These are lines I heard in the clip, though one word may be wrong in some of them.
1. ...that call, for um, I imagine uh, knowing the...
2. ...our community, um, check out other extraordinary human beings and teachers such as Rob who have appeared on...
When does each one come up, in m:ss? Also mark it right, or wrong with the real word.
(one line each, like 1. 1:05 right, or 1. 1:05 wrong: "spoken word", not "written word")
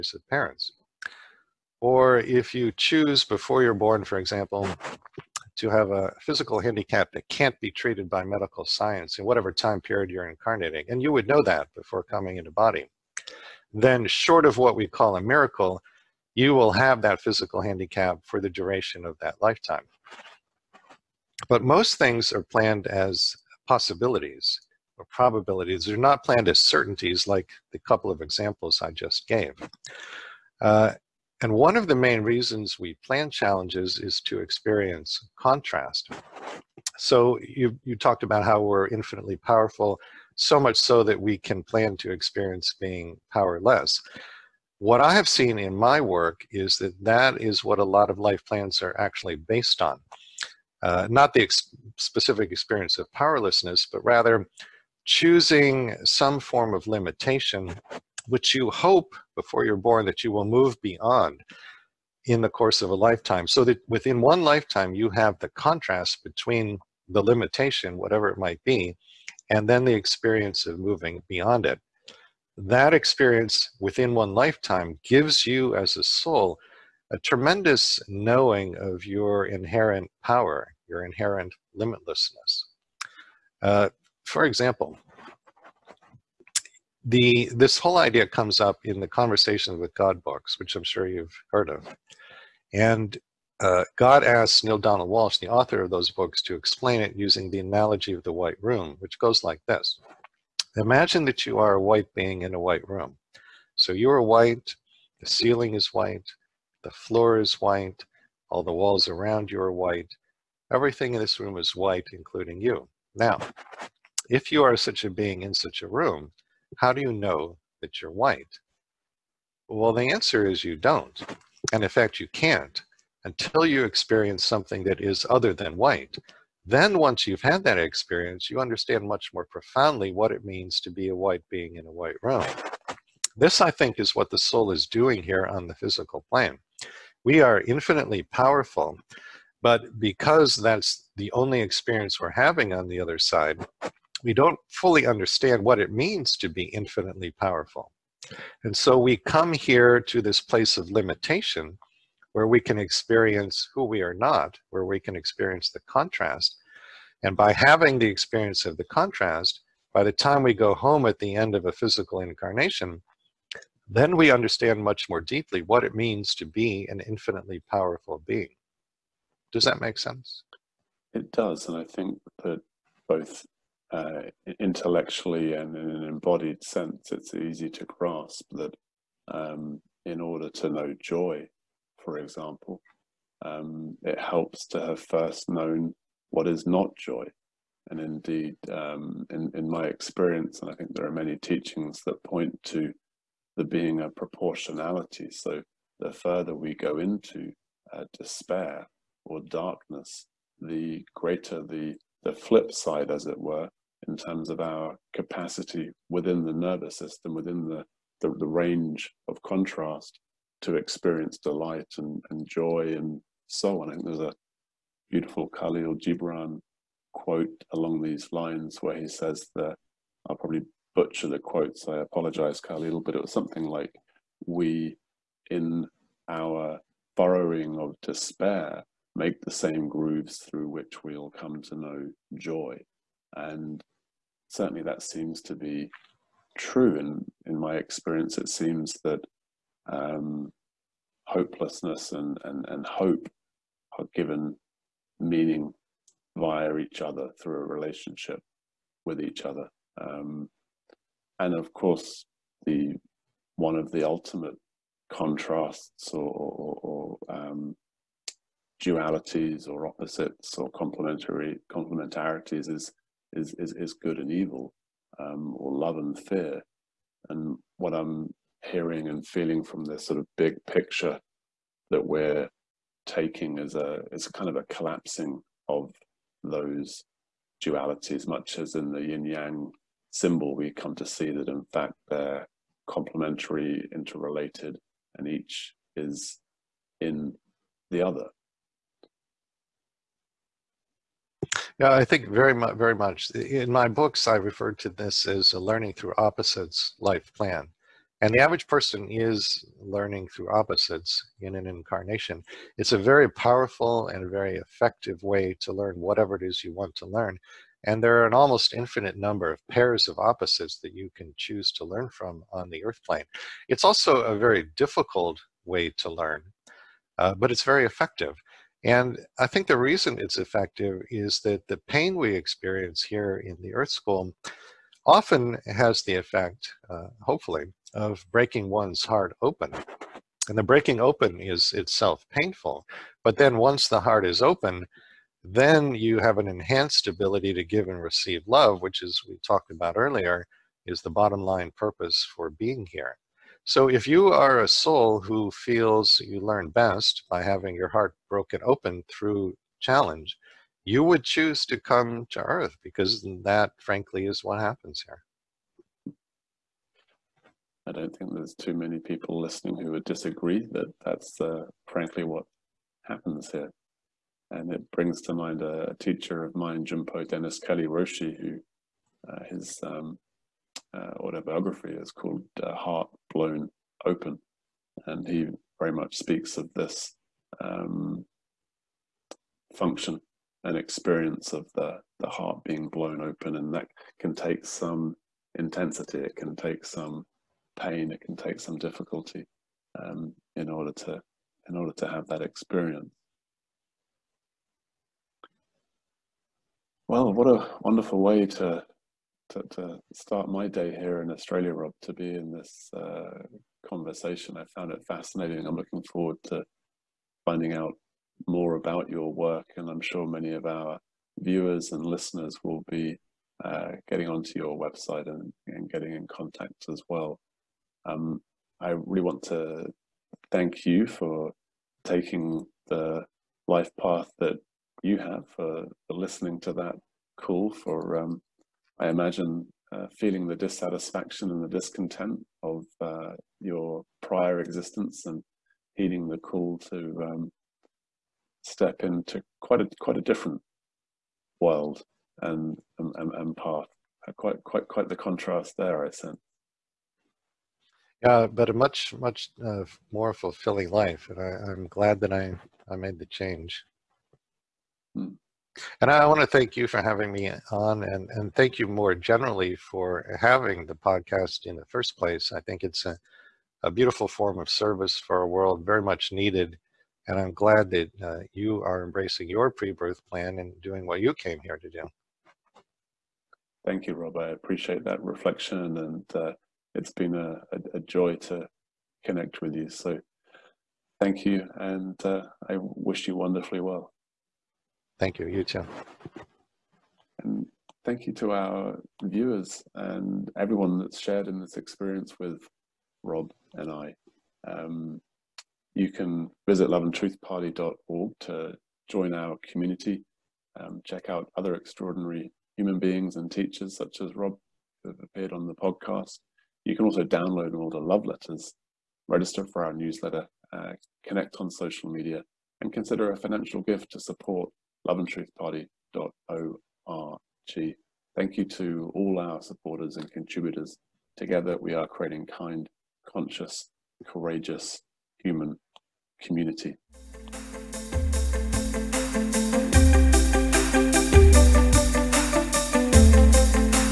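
1. 7:06 wrong: "feeling", not "knowing"
2. 8:19 right.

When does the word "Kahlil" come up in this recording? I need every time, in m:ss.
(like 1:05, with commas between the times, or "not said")
3:35, 3:42.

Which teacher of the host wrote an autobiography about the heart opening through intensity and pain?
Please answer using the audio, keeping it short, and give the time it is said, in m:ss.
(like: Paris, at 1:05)
Junpo Denis Kelly Roshi, at 6:06.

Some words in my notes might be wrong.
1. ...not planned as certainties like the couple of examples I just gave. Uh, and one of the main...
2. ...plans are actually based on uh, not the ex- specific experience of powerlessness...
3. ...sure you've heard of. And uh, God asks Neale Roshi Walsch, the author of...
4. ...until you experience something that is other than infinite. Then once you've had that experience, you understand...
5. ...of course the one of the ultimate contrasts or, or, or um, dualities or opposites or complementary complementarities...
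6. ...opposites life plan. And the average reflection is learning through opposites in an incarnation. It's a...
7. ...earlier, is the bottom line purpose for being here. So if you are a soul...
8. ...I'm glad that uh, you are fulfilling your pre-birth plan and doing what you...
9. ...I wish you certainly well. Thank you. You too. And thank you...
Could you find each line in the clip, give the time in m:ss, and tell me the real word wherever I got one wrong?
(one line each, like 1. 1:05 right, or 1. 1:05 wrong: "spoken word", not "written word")
1. 0:25 right
2. 0:48 right
3. 1:30 wrong: "Donald", not "Roshi"
4. 2:03 wrong: "white", not "infinite"
5. 4:11 right
6. 4:56 wrong: "person", not "reflection"
7. 5:39 right
8. 7:47 wrong: "embracing", not "fulfilling"
9. 8:02 wrong: "wonderfully", not "certainly".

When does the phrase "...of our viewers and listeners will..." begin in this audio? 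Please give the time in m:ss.
6:50.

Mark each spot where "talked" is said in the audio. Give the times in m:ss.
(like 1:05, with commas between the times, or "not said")
0:37, 5:39.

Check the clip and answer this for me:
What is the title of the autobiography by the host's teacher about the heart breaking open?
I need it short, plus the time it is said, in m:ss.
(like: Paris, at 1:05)
Heart Blown Open, at 6:12.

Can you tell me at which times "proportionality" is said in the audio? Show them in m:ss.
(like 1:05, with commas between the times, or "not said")
3:14.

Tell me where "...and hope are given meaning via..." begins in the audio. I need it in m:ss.
4:02.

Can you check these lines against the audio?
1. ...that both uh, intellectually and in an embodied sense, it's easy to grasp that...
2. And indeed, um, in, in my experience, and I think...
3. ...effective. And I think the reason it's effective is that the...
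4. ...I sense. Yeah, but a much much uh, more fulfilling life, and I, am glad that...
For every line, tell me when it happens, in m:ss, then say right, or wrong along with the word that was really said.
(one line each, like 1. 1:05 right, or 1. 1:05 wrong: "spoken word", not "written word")
1. 2:52 right
2. 3:07 right
3. 5:17 right
4. 7:26 right.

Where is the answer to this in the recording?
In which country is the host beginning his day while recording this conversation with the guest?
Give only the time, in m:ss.
6:41.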